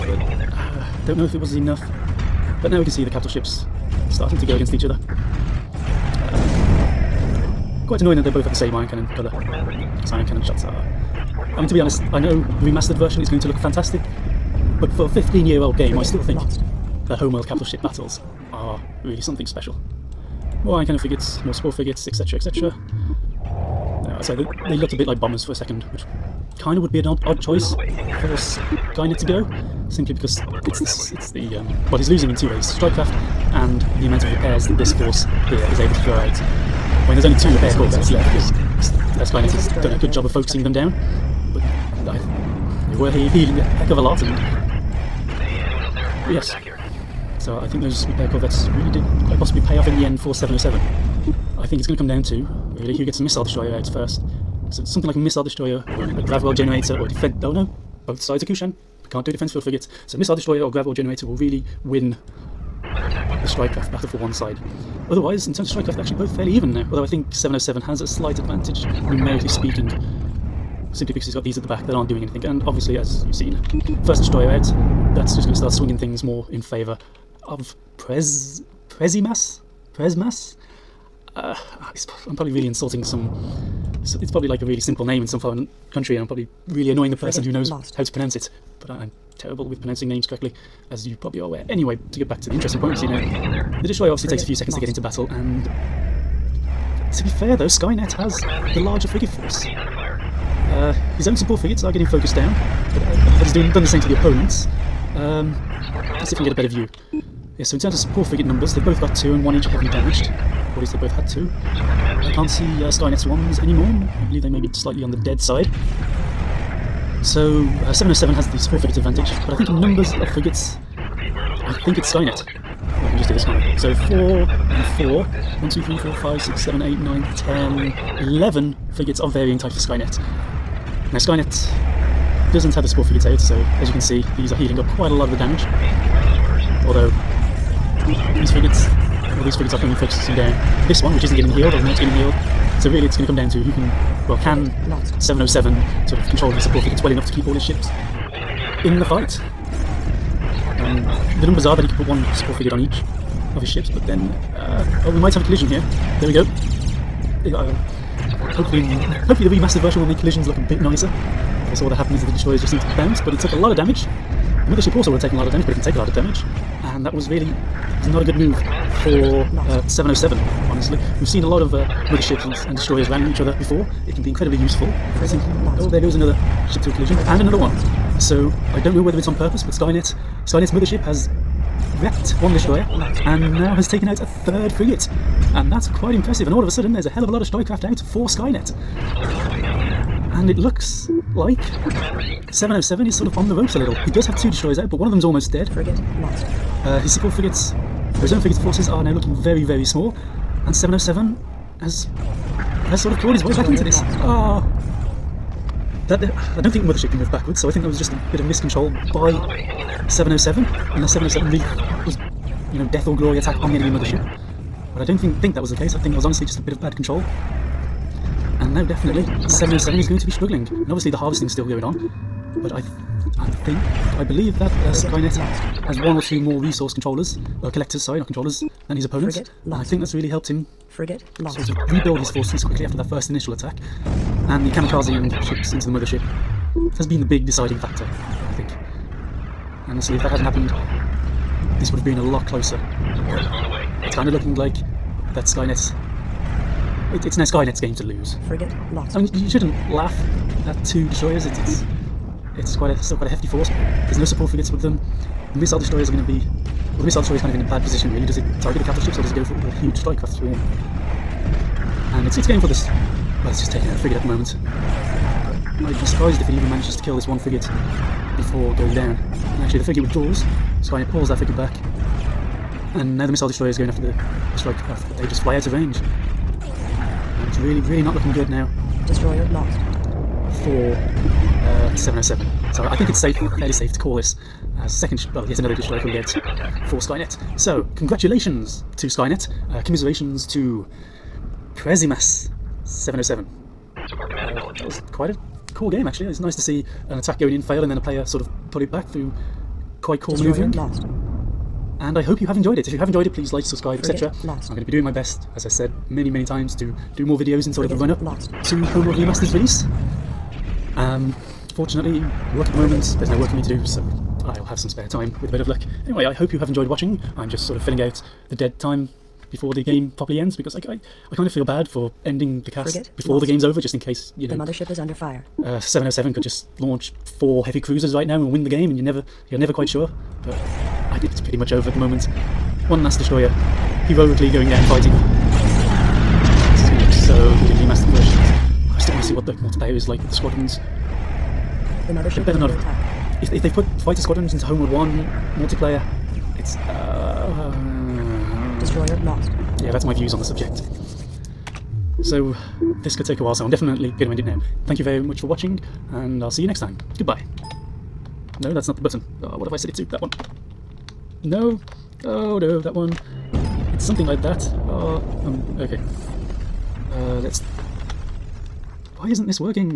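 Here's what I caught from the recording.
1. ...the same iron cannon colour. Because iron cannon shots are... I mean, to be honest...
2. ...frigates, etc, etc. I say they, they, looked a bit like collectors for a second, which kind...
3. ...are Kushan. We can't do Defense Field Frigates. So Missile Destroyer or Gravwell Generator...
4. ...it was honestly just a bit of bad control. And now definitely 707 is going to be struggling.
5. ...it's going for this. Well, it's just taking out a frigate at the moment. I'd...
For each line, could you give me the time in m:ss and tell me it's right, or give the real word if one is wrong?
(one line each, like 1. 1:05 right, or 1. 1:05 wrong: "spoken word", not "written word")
1. 0:08 right
2. 0:21 wrong: "bombers", not "collectors"
3. 0:58 right
4. 3:36 right
5. 4:22 right.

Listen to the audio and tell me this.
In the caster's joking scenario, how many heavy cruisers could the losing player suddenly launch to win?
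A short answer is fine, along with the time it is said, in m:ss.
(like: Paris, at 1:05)
4, at 5:27.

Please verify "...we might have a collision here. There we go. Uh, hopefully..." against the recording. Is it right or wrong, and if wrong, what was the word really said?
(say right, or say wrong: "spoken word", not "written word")
right.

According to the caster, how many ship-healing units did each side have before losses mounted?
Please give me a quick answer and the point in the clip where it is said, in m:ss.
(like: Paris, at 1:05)
2, at 1:48.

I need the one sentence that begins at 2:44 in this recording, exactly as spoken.
The mothership also would have taken a lot of damage, but it can take a lot of damage.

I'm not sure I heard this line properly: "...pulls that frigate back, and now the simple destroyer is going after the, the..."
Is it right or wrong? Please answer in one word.
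wrong.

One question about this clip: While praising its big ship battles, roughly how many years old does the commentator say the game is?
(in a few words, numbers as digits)
15.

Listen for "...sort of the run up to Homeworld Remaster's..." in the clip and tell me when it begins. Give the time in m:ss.
5:07.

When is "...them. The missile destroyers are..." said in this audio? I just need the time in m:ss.
4:14.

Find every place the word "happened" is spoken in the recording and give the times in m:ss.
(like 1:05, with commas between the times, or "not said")
2:41, 4:00.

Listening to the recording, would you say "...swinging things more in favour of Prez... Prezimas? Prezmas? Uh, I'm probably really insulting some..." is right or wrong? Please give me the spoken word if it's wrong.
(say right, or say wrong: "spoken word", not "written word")
right.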